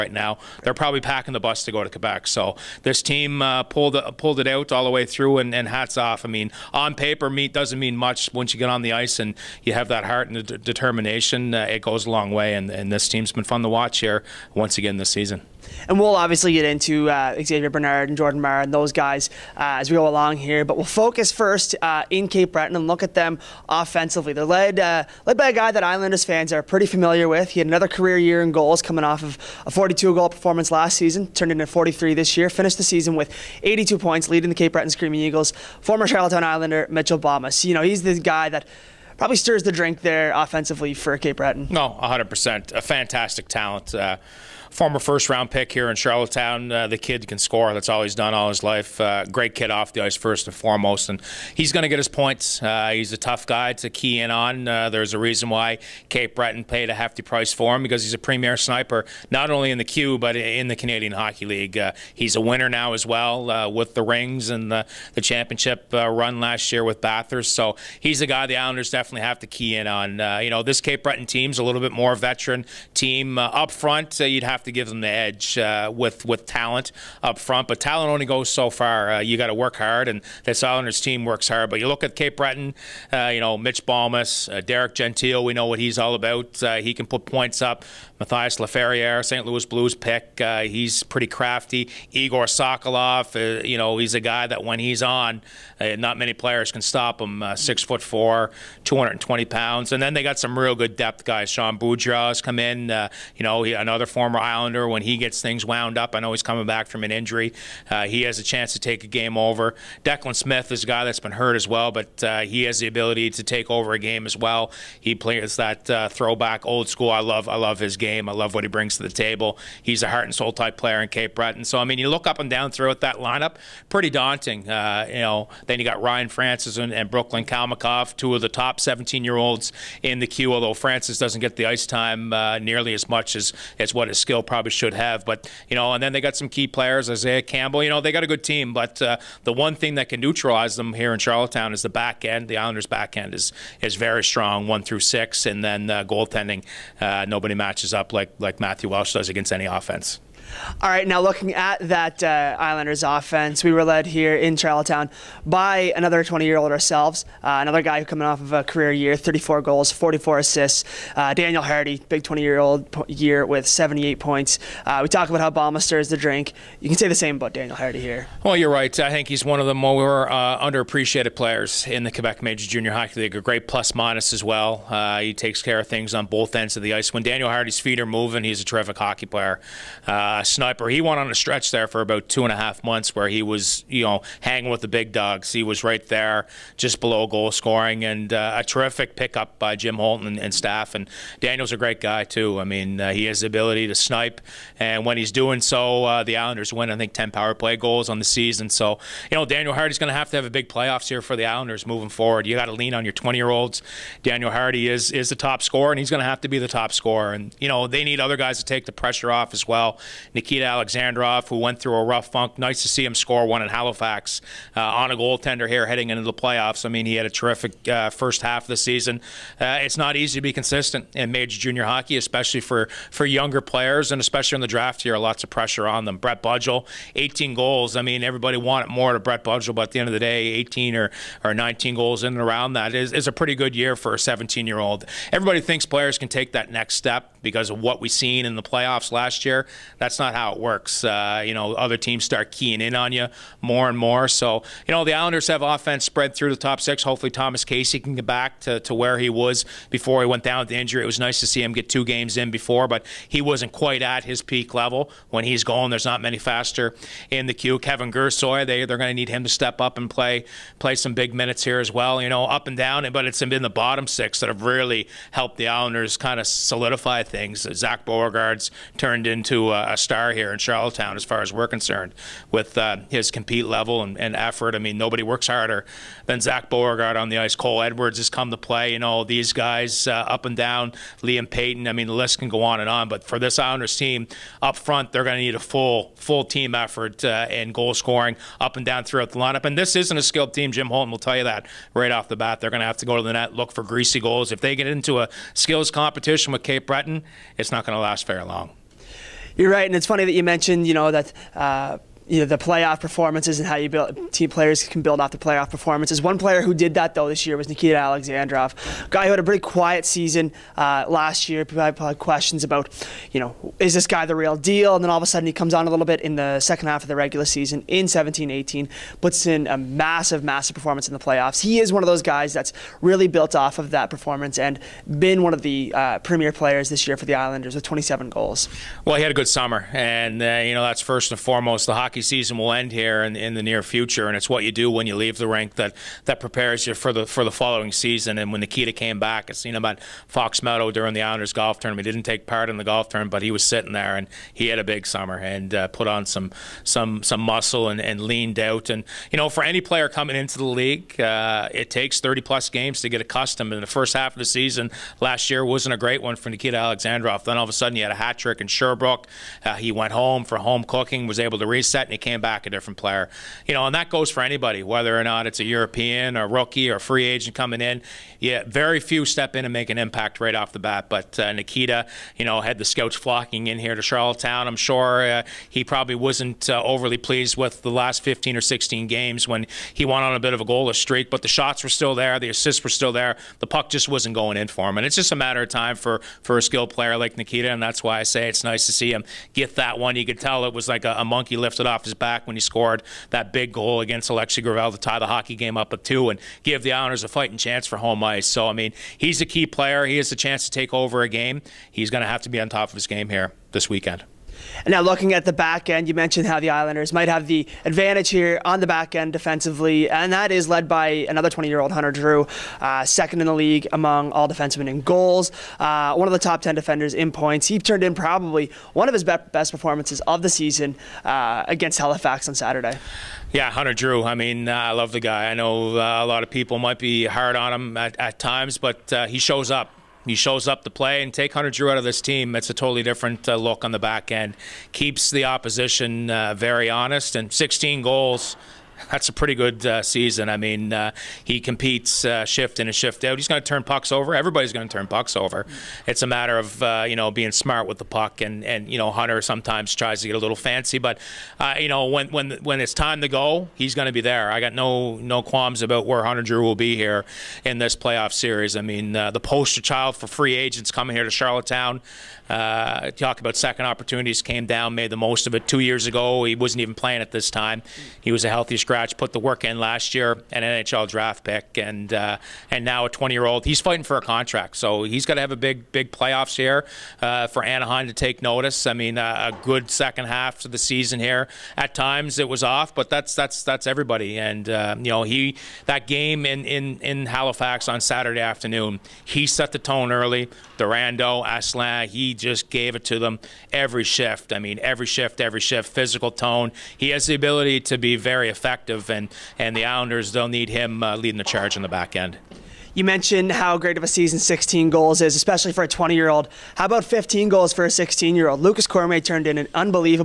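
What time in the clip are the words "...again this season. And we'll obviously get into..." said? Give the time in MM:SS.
00:14.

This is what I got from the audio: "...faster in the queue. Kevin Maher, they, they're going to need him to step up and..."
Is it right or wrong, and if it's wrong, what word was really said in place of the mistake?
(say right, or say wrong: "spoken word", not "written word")
wrong: "Gersoy", not "Maher".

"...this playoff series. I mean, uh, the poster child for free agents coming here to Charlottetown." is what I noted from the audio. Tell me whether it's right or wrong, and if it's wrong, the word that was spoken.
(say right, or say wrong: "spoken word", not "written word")
right.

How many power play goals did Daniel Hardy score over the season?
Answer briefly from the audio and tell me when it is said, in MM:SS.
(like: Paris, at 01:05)
10, at 03:17.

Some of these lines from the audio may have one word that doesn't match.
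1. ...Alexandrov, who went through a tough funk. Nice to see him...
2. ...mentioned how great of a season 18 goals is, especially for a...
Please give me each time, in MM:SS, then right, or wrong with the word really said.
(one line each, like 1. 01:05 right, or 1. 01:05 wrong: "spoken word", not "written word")
1. 03:30 wrong: "rough", not "tough"
2. 08:23 wrong: "16", not "18".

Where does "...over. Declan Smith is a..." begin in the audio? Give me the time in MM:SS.
01:49.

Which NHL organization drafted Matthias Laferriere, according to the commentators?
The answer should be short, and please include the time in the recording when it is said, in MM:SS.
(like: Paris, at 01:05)
St. Louis Blues, at 01:29.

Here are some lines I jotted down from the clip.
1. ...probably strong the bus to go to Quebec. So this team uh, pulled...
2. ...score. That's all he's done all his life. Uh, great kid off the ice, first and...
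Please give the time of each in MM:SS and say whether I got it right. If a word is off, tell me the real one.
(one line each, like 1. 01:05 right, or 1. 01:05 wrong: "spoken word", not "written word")
1. 00:00 wrong: "packing", not "strong"
2. 00:47 right.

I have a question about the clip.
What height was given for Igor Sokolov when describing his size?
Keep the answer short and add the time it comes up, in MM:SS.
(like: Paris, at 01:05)
6 foot 4, at 01:37.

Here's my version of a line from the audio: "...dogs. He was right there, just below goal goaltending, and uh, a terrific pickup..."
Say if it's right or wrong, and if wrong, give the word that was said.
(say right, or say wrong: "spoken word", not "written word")
wrong: "scoring", not "goaltending".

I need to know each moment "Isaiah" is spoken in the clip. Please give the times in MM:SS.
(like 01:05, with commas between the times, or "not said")
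02:17.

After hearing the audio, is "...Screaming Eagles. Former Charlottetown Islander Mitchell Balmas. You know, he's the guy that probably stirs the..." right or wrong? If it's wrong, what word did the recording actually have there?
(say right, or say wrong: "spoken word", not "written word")
right.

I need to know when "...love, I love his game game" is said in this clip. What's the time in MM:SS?
01:57.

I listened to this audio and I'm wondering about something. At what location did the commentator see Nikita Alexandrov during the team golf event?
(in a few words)
Fox Meadow.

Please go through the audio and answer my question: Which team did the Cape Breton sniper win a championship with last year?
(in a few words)
Bathurst.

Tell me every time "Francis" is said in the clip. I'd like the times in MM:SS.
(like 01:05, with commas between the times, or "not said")
02:06, 02:10.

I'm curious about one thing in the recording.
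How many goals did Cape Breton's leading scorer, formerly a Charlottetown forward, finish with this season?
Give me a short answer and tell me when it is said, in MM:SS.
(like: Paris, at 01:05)
43, at 00:31.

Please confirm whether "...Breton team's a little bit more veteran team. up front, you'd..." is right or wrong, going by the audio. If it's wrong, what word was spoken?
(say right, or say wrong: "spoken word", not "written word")
right.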